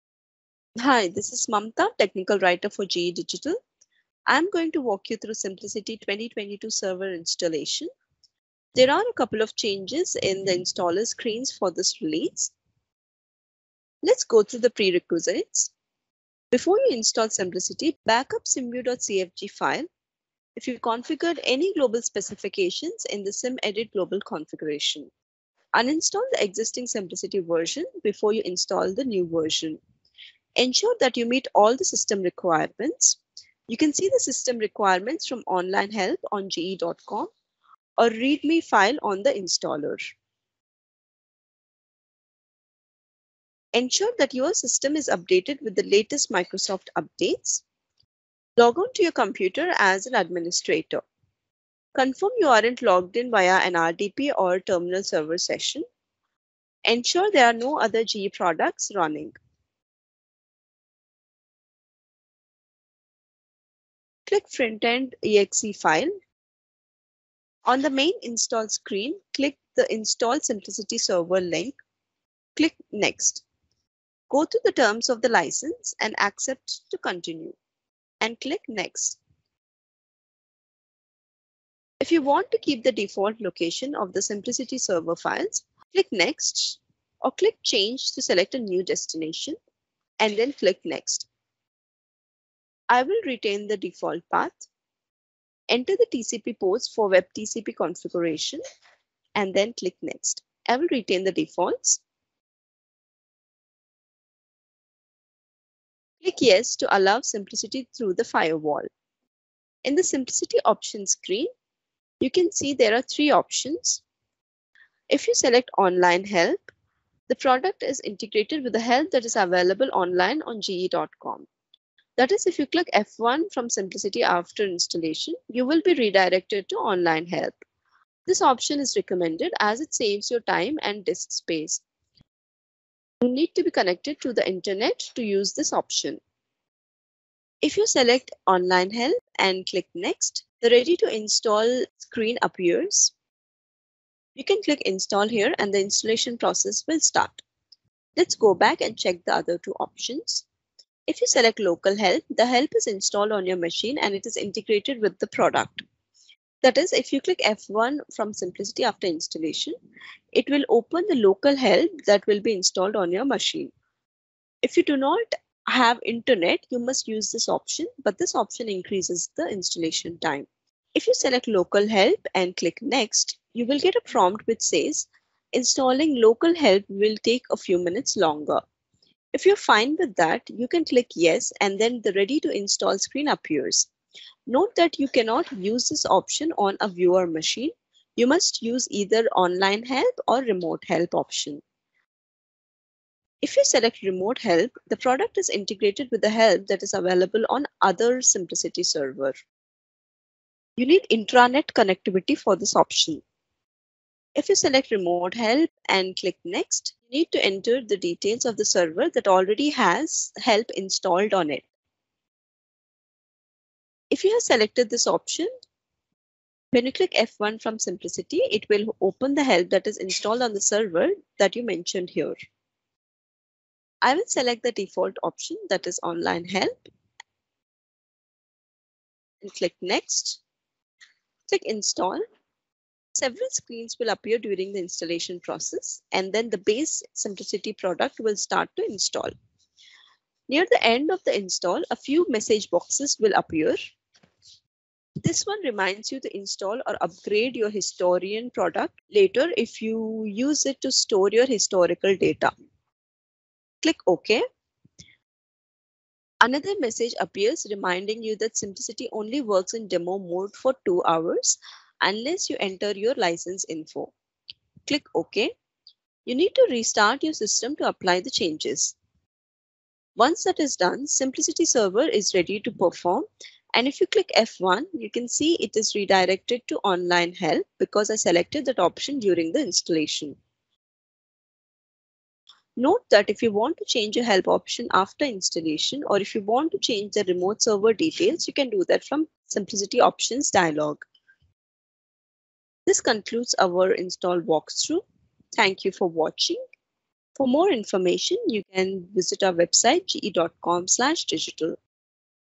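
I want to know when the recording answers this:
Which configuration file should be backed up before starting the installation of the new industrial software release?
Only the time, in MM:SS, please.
00:18.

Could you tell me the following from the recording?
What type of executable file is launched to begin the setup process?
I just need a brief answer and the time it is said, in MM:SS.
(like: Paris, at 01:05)
Frontend exe, at 01:04.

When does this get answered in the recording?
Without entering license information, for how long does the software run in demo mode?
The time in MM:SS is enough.
04:20.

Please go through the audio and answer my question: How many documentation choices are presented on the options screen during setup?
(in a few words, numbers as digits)
3.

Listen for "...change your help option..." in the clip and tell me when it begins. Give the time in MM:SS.
04:43.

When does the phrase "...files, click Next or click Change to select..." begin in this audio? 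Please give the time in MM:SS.
01:25.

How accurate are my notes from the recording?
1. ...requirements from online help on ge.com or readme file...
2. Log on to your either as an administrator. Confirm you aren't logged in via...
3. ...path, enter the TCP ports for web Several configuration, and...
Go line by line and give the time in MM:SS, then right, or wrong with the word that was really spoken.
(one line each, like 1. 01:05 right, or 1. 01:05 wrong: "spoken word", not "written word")
1. 00:34 right
2. 00:48 wrong: "computer", not "either"
3. 01:34 wrong: "TCP", not "Several".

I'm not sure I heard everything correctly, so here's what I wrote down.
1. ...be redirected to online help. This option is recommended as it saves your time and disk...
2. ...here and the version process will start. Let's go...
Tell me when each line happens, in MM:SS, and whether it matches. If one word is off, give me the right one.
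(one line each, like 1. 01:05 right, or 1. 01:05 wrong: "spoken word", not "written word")
1. 02:05 right
2. 02:25 wrong: "installation", not "version".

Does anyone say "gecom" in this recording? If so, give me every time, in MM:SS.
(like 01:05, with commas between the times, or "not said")
00:36, 02:00, 05:00.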